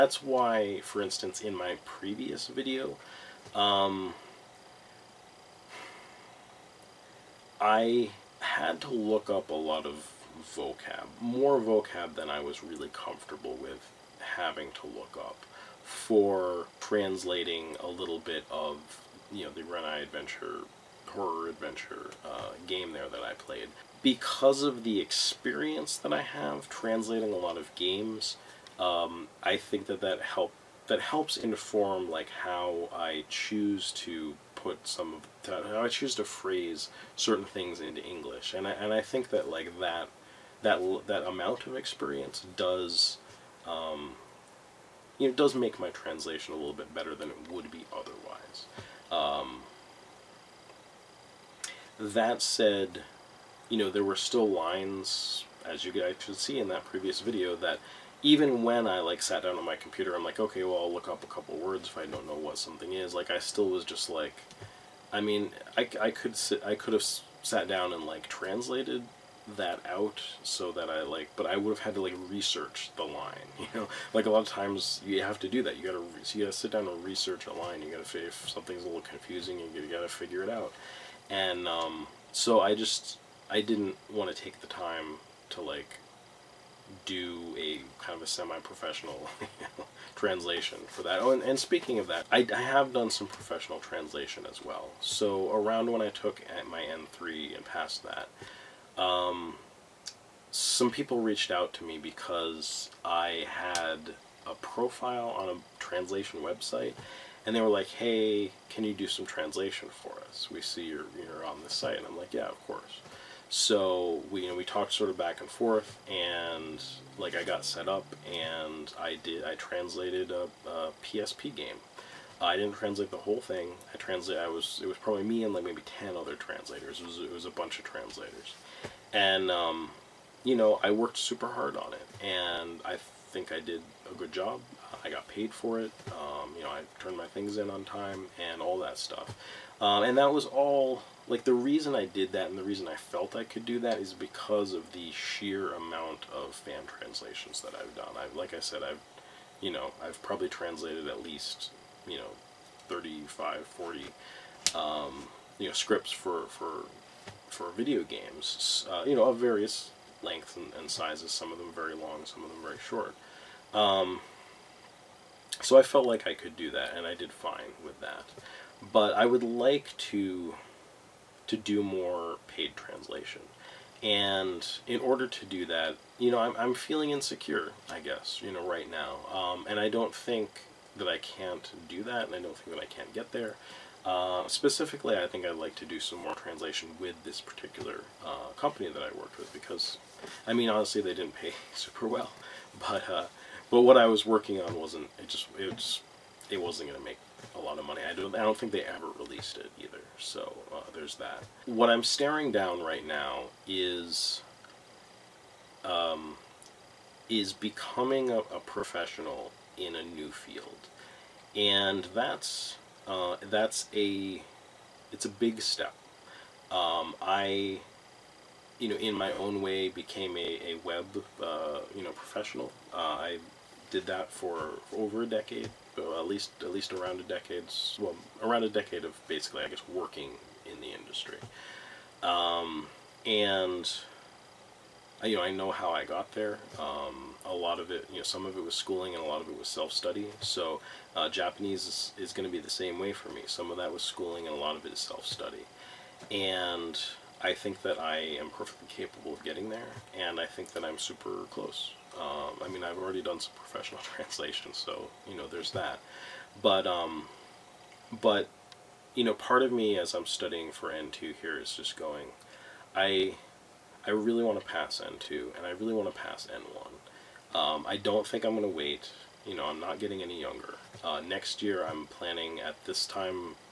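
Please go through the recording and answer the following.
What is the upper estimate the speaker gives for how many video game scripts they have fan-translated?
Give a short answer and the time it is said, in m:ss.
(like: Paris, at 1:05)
40, at 2:33.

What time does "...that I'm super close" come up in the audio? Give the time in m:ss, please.
4:10.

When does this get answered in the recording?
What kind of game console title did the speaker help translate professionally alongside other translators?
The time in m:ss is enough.
2:01.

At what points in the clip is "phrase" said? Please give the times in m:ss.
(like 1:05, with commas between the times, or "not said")
0:36.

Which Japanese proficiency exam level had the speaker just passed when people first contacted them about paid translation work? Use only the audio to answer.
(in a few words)
N3.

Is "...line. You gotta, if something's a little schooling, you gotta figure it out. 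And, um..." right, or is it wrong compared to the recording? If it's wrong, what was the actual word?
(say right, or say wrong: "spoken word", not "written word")
wrong: "confusing", not "schooling".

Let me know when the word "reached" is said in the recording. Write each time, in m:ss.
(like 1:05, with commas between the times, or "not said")
1:41.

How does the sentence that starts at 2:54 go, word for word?
And in order to do that, you know, I'm, I'm feeling insecure, I guess, you know, right now.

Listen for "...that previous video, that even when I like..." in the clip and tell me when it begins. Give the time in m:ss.
0:56.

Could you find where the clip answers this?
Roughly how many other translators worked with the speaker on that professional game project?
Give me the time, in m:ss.
2:05.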